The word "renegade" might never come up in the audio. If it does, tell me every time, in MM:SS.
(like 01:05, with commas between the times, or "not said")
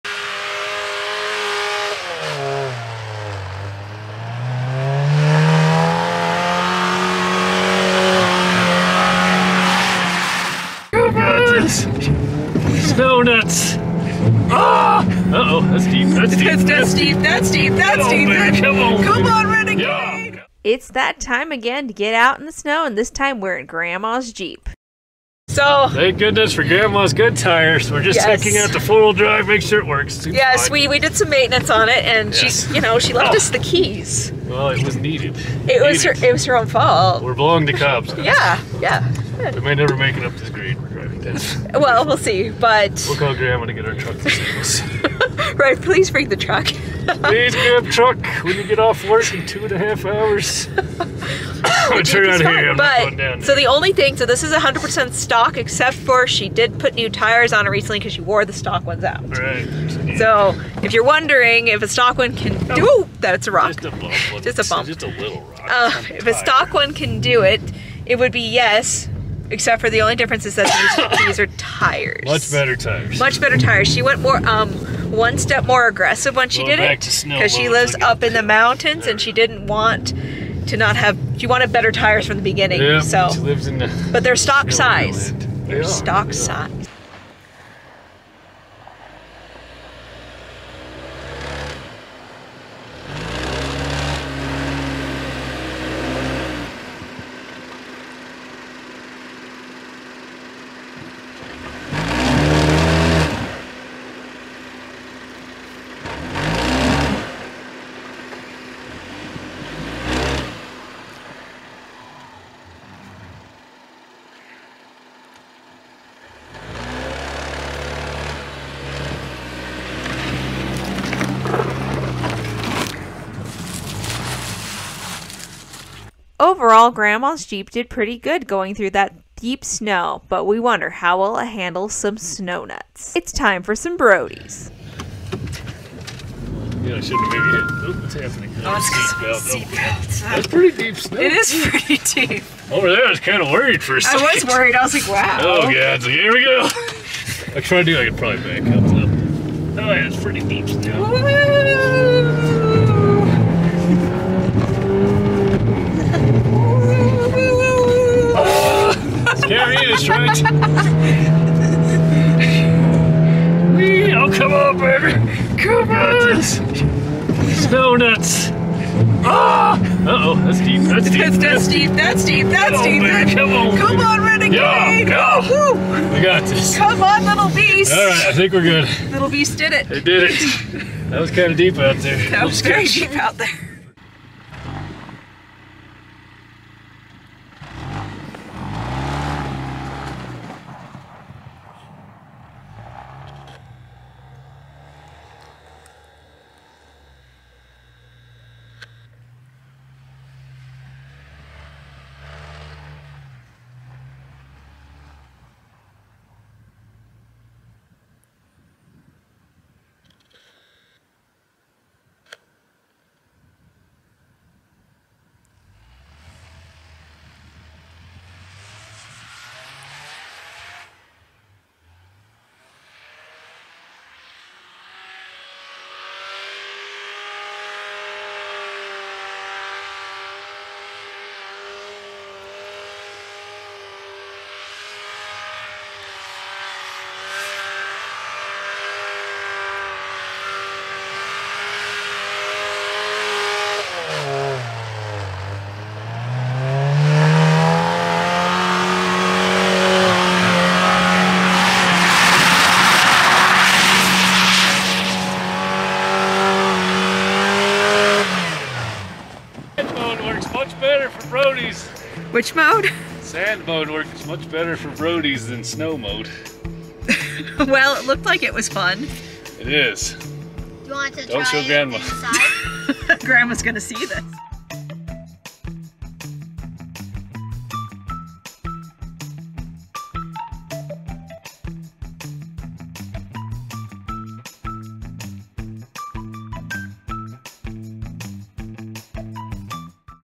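00:19, 02:54.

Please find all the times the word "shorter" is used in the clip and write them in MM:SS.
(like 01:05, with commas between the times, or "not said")
not said.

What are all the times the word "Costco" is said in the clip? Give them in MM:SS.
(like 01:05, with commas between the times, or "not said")
not said.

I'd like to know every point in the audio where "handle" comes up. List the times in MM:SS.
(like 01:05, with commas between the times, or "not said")
02:11.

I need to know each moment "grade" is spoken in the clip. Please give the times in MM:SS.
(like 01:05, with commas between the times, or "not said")
00:40.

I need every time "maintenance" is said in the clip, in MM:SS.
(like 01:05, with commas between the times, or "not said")
00:31.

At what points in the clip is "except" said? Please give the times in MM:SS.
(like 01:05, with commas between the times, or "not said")
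00:55, 01:09.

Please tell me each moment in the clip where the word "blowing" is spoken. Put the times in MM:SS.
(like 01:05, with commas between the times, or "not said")
00:37.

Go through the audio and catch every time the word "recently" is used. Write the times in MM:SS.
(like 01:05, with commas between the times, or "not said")
00:57.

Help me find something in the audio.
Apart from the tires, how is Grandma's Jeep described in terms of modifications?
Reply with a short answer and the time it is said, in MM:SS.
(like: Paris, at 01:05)
100% stock, at 00:54.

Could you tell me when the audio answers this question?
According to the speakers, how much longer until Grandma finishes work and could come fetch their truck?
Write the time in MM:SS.
00:49.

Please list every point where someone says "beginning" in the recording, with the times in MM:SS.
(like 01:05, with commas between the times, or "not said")
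01:22.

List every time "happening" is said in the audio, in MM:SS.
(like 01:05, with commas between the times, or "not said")
02:18.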